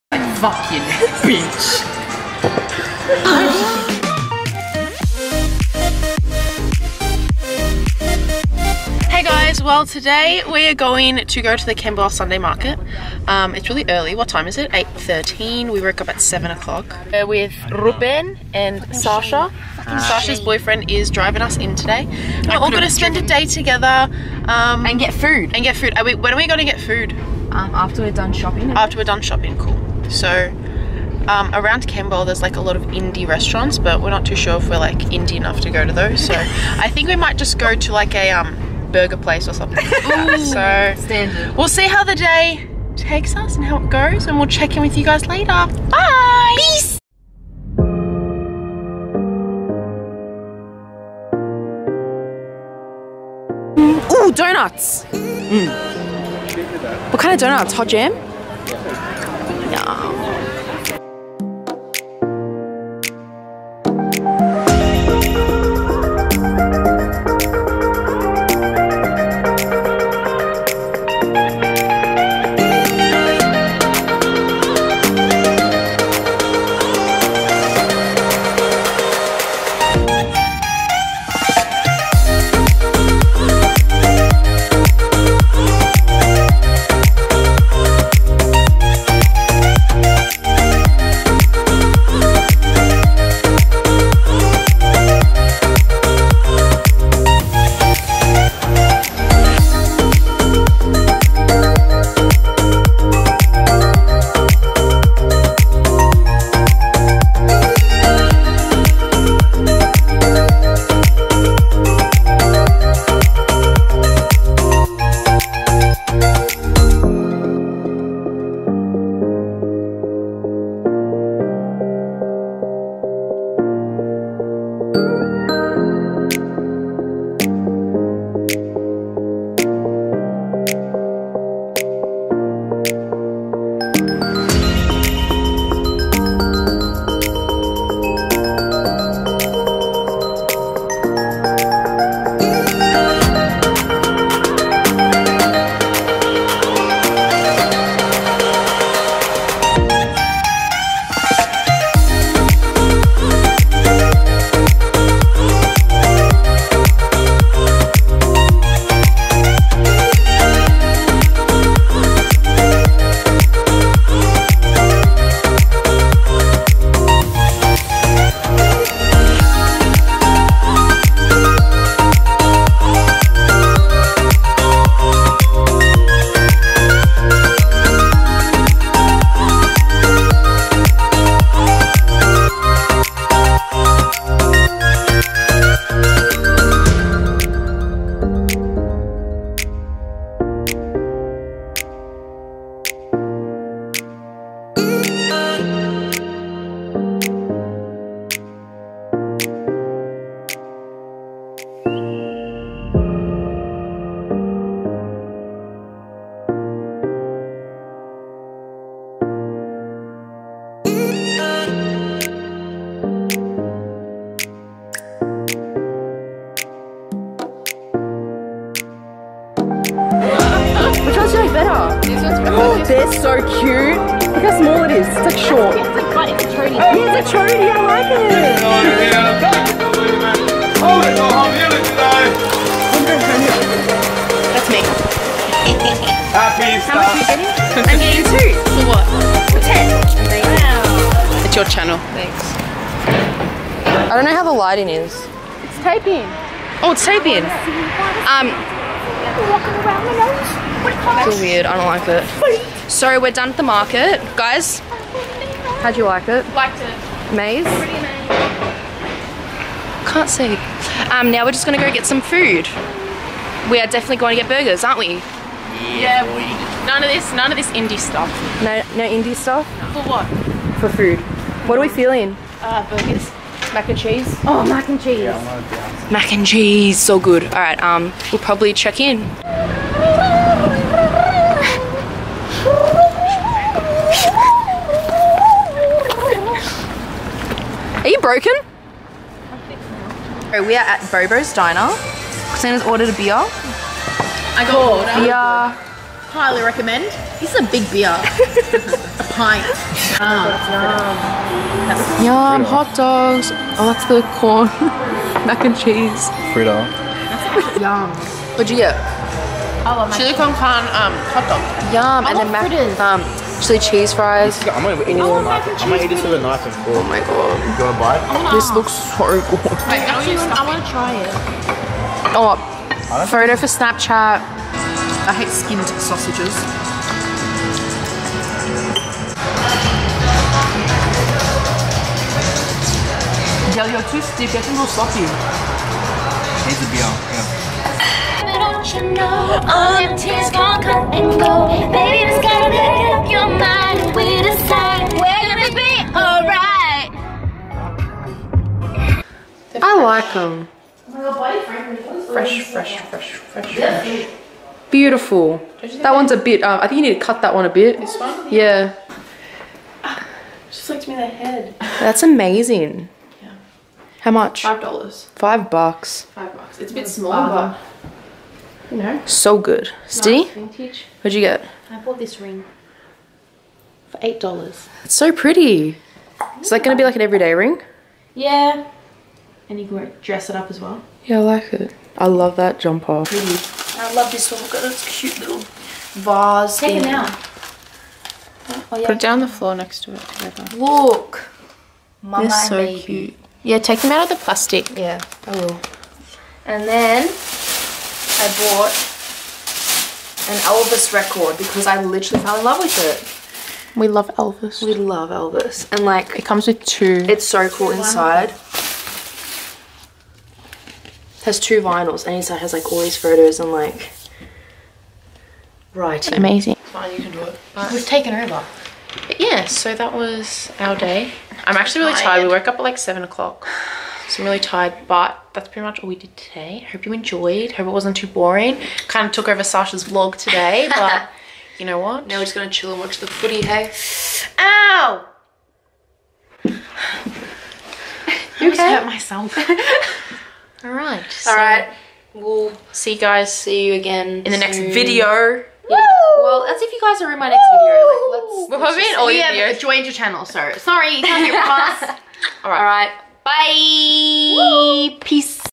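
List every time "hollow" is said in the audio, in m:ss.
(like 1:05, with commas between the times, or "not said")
not said.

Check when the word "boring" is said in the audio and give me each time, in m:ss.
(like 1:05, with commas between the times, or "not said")
7:08.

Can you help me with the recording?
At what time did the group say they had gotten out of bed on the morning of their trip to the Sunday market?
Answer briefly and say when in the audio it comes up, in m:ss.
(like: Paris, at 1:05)
7 o'clock, at 0:16.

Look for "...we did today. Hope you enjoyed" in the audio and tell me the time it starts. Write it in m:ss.
7:06.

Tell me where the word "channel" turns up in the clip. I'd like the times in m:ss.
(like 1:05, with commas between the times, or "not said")
4:01, 7:30.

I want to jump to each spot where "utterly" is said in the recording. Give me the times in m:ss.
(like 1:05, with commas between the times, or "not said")
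not said.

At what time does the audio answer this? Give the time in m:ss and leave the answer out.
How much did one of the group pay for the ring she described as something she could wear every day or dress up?
6:14.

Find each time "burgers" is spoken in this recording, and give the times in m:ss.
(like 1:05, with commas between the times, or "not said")
0:38, 4:24, 4:32.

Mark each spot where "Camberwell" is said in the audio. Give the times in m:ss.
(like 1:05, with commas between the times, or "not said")
0:11, 0:31.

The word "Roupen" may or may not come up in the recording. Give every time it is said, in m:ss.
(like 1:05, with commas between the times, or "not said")
0:17.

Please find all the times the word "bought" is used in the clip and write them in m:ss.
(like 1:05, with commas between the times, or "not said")
6:12, 6:38.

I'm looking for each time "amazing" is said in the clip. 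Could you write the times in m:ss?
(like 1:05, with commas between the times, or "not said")
6:02, 6:56.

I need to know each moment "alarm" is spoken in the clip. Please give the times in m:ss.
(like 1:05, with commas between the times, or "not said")
not said.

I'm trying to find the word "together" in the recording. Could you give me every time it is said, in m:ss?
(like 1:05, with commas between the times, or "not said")
0:23, 6:30.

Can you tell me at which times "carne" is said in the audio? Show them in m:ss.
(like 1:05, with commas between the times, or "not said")
5:10.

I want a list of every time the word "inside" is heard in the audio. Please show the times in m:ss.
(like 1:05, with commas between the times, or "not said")
6:47, 6:52.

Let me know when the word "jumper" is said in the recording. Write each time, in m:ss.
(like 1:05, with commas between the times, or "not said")
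6:22.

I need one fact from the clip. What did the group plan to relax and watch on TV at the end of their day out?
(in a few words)
The footy.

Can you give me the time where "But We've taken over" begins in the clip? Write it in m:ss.
6:57.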